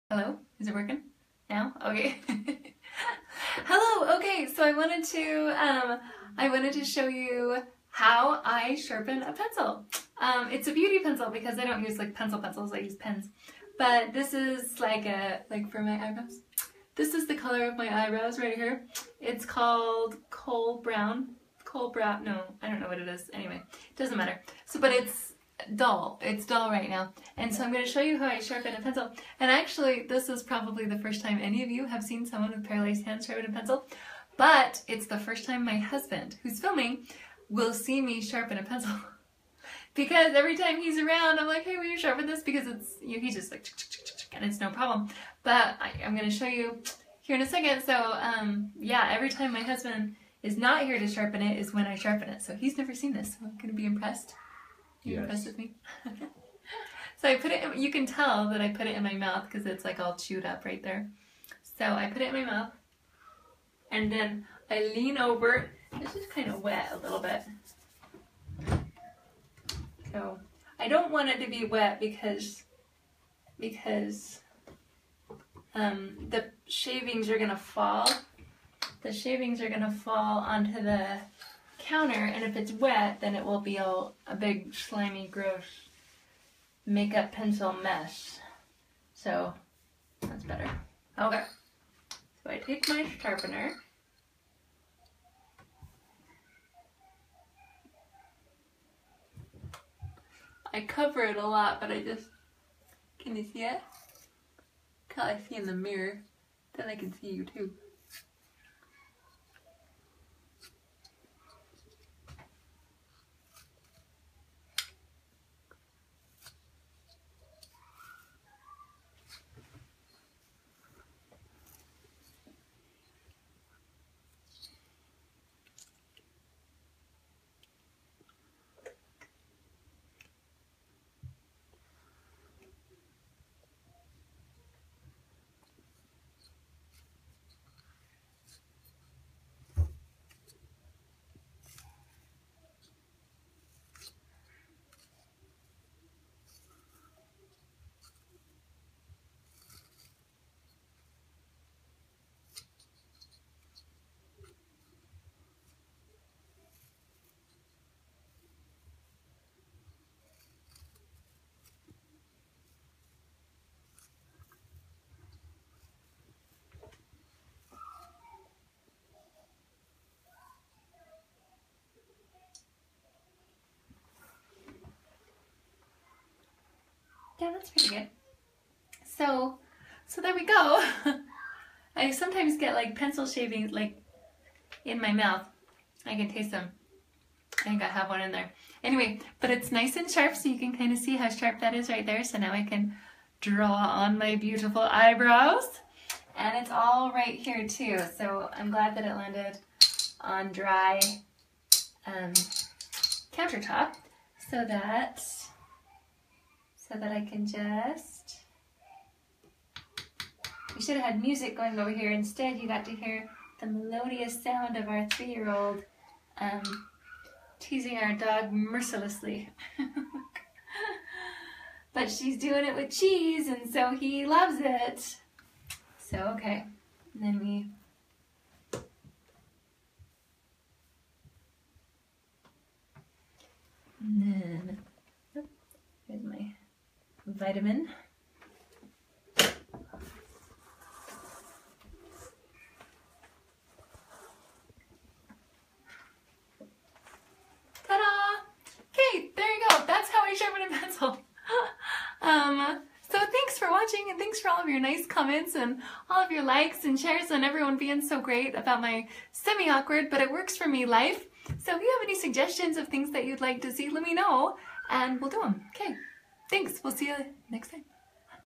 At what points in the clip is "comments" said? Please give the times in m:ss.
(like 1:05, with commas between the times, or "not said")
4:15.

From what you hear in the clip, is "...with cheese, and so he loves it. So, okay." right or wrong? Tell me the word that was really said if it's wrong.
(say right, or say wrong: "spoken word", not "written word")
right.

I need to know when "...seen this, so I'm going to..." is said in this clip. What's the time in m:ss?
0:52.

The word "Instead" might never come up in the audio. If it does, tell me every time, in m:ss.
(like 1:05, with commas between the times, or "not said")
3:32.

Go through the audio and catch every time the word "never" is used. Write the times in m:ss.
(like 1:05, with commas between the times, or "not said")
0:52.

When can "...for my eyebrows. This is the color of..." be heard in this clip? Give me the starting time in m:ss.
0:15.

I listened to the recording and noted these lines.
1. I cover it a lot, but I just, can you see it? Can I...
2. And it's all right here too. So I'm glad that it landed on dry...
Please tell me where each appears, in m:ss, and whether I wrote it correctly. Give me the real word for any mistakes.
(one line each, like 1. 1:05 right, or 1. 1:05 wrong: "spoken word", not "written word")
1. 1:40 right
2. 3:16 right.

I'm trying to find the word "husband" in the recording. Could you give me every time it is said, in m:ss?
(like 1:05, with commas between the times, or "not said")
0:35, 0:49.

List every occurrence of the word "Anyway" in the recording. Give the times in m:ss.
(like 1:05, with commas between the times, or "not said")
0:23, 3:08.